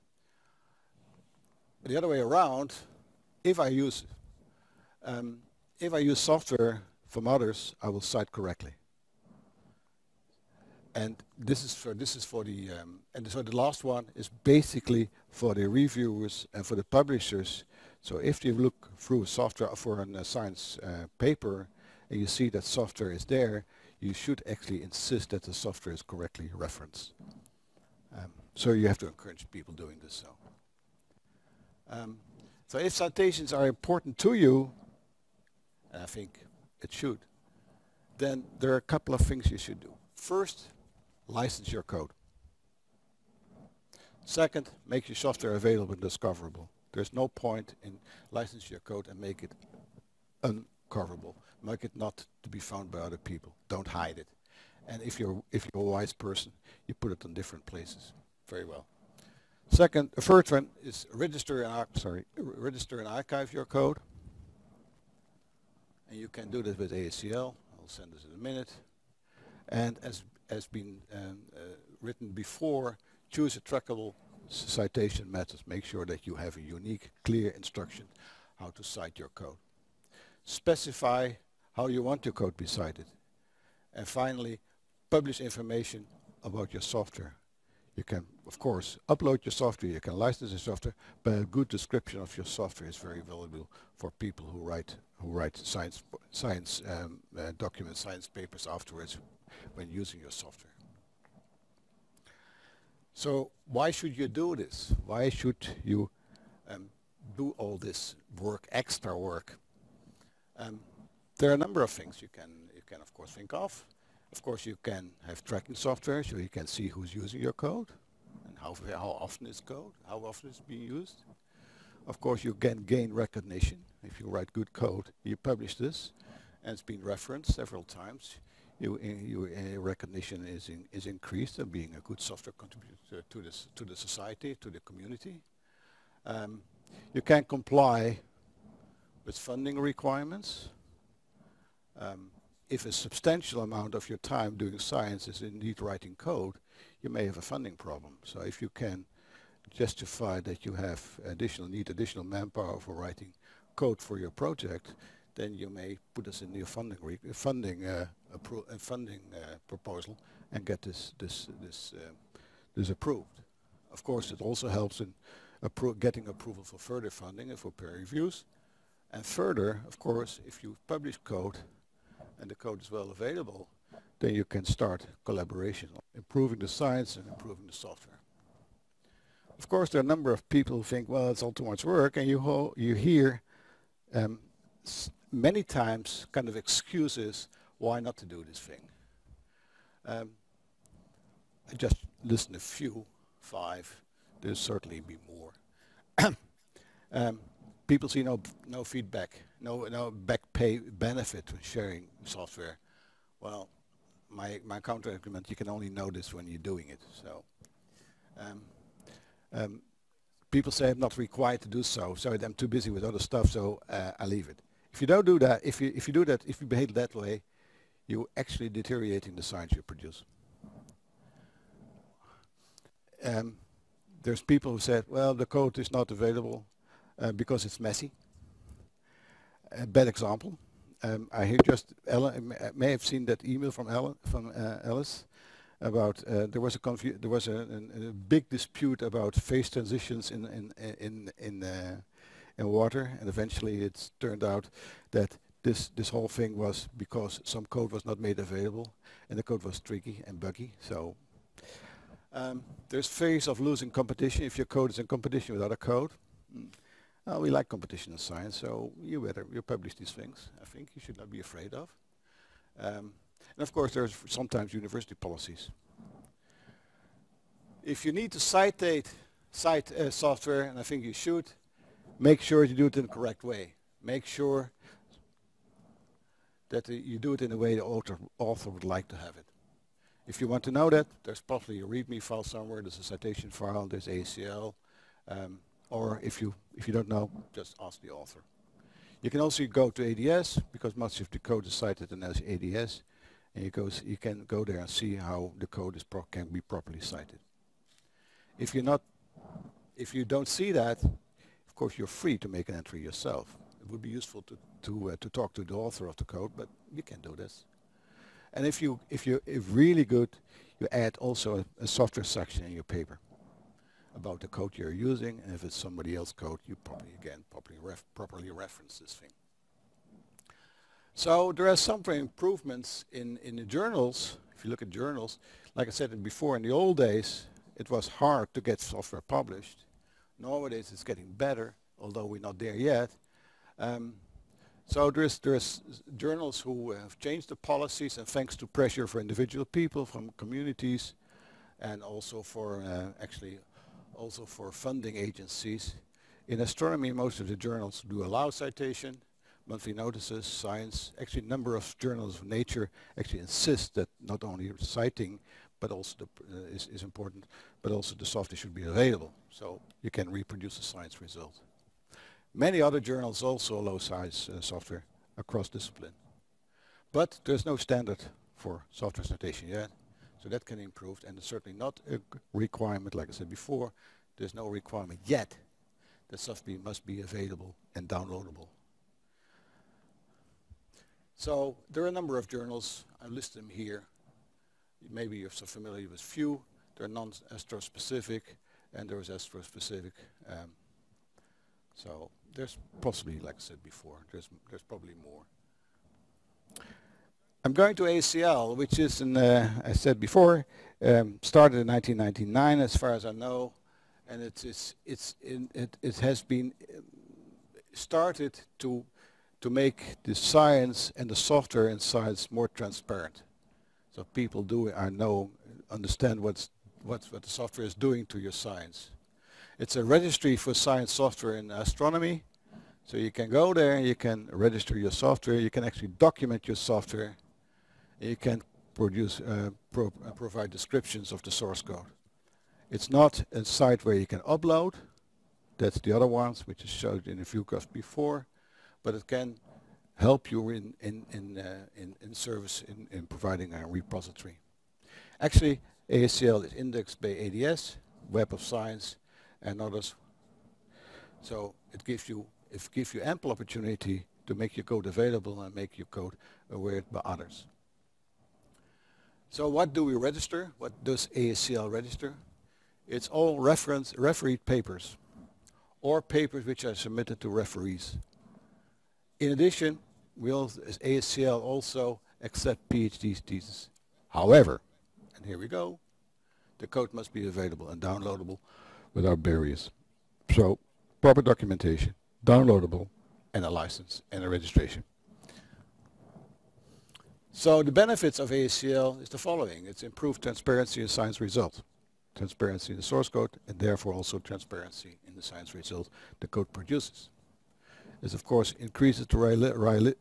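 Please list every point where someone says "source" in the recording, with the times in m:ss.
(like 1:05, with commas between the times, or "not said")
7:11, 8:13.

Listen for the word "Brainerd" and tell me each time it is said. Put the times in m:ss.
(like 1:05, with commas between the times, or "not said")
not said.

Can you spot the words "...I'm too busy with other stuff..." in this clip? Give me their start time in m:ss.
3:32.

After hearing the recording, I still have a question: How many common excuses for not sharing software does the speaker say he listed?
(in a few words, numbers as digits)
5.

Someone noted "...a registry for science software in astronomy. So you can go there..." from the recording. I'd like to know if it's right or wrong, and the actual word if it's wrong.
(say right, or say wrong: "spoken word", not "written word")
right.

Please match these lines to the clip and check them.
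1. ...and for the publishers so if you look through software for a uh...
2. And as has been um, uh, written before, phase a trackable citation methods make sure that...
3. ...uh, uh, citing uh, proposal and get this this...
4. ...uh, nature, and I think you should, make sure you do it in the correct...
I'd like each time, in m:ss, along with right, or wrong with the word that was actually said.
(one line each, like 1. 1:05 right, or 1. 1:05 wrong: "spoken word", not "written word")
1. 0:16 right
2. 1:09 wrong: "choose", not "phase"
3. 2:37 wrong: "funding", not "citing"
4. 4:29 wrong: "software", not "nature".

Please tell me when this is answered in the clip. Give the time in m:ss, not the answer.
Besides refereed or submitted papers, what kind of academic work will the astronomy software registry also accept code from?
7:52.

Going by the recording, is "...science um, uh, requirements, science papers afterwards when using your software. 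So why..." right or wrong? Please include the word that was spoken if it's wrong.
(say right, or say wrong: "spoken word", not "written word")
wrong: "documents", not "requirements".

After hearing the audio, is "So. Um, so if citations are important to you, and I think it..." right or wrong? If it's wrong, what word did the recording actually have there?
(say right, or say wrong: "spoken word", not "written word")
right.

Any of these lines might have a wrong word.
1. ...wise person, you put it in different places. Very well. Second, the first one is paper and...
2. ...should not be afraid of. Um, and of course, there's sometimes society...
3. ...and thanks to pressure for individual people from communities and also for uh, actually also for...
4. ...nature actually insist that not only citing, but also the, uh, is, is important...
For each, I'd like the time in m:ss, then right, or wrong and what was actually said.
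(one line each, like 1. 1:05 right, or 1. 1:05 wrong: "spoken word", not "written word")
1. 0:55 wrong: "register", not "paper"
2. 4:21 wrong: "university", not "society"
3. 5:38 right
4. 5:52 right.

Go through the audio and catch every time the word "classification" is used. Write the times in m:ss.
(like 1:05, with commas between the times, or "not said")
not said.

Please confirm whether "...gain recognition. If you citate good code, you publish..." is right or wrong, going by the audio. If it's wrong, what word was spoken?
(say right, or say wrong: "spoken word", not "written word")
wrong: "write", not "citate".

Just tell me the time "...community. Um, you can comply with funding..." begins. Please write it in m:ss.
2:14.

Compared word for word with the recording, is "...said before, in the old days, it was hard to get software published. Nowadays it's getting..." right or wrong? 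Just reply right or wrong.
right.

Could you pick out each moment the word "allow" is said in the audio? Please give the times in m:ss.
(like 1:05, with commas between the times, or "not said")
5:48, 6:03.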